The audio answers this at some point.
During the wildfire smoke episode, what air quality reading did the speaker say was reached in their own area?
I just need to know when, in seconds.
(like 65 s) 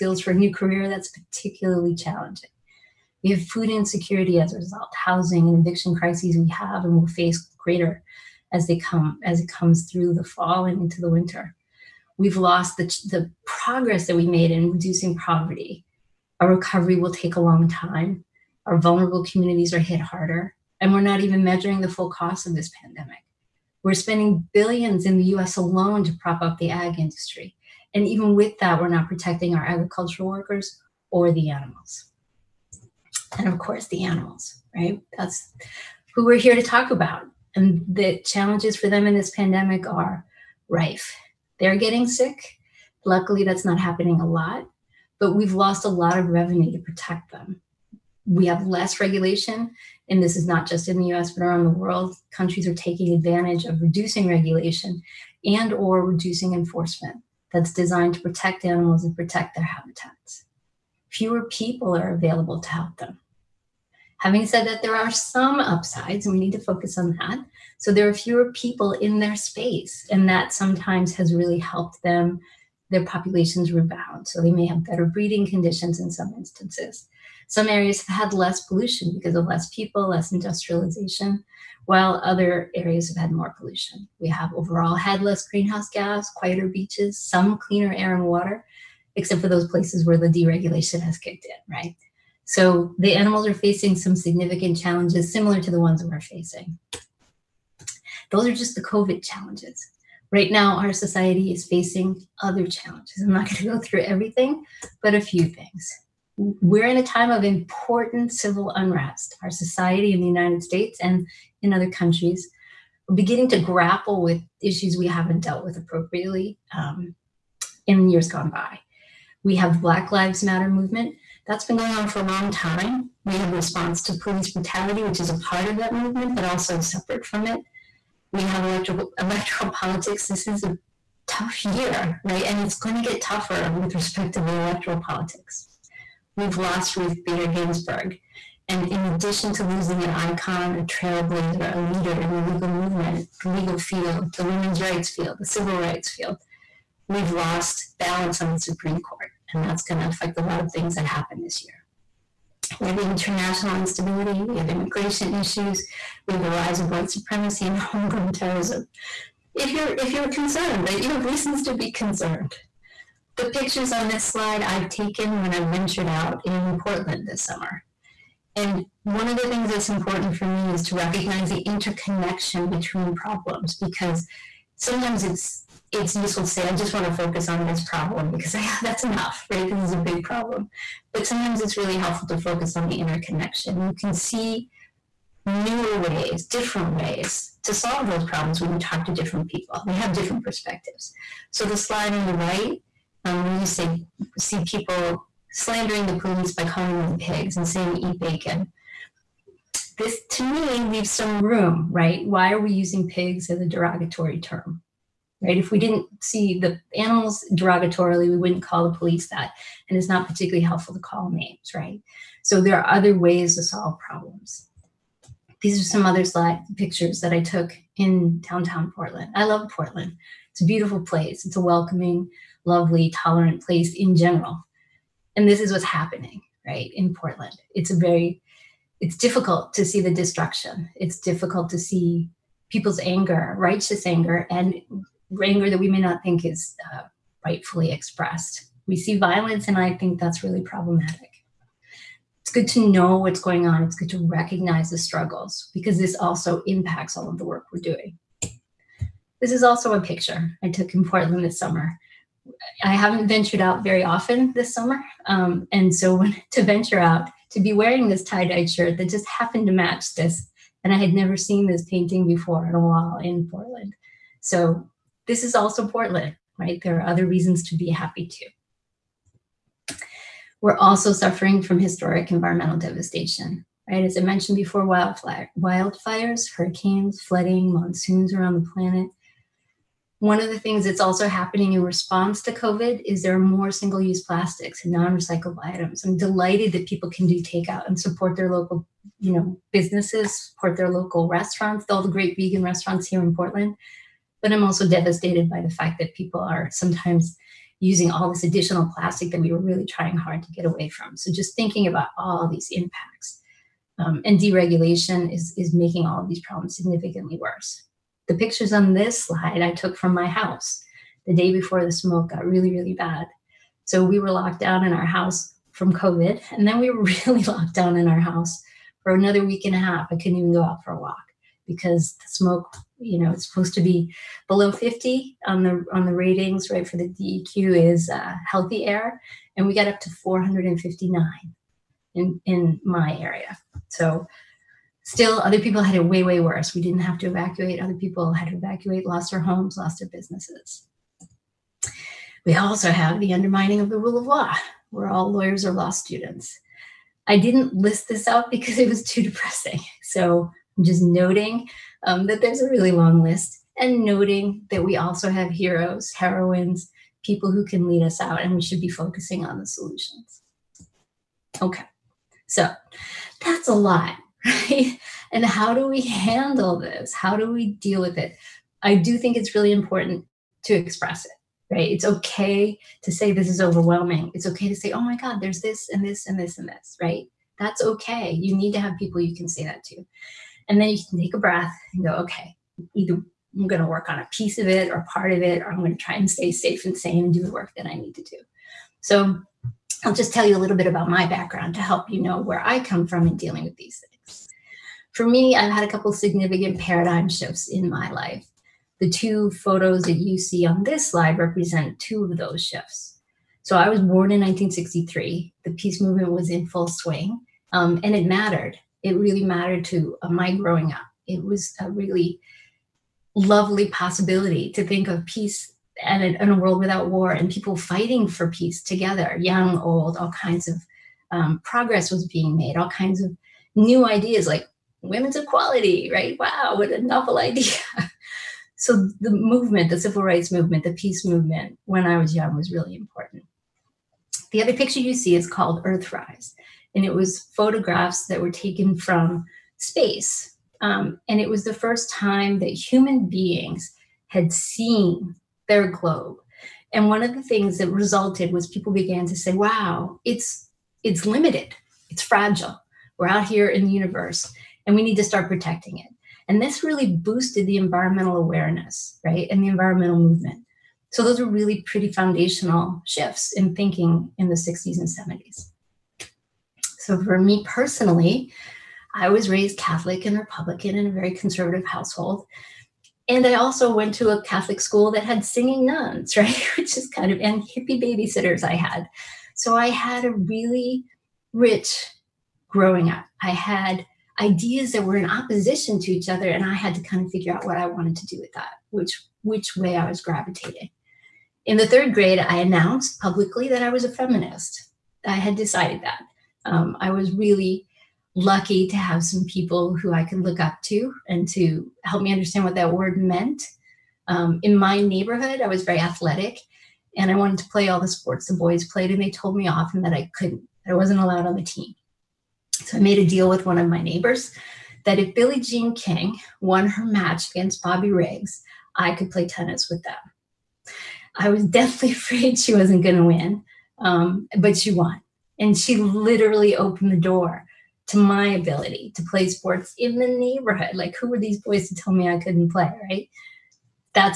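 330 s.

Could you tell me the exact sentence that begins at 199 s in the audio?
This to me leaves some room, right?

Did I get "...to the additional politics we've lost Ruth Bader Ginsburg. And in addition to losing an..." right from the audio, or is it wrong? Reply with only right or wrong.
wrong.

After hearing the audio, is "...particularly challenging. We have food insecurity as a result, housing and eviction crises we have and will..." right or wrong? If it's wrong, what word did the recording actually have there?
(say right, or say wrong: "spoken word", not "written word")
right.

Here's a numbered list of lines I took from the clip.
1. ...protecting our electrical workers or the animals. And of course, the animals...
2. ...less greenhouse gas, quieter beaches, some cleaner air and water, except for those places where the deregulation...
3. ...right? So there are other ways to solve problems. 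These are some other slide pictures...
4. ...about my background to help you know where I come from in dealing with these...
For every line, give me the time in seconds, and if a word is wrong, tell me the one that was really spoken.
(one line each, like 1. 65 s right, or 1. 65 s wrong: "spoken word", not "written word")
1. 29 s wrong: "agricultural", not "electrical"
2. 85 s right
3. 211 s right
4. 390 s right.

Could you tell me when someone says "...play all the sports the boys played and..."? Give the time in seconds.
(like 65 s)
507 s.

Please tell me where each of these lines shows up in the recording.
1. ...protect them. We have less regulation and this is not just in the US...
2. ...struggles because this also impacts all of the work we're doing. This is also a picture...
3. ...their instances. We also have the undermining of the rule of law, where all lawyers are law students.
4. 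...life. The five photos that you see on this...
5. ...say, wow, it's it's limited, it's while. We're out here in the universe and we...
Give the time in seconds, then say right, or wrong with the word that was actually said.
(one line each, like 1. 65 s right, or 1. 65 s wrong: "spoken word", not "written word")
1. 46 s right
2. 244 s right
3. 339 s wrong: "businesses", not "instances"
4. 398 s wrong: "two", not "five"
5. 449 s wrong: "fragile", not "while".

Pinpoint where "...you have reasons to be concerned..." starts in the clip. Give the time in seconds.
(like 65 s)
161 s.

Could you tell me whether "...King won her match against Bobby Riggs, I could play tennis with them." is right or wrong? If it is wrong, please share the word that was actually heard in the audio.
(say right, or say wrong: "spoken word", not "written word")
right.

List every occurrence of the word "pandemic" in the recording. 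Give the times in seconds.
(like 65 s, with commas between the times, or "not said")
22 s, 39 s.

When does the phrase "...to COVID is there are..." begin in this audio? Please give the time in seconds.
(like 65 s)
282 s.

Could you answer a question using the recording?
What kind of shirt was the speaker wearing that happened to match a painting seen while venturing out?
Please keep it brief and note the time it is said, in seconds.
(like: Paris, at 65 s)
tie dye shirt, at 258 s.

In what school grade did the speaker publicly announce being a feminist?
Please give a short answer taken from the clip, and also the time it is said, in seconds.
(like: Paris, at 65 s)
third grade, at 491 s.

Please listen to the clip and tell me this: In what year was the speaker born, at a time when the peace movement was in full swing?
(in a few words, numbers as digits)
1963.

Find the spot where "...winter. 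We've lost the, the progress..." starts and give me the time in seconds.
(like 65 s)
11 s.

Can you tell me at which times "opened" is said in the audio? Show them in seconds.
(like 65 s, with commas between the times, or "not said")
526 s.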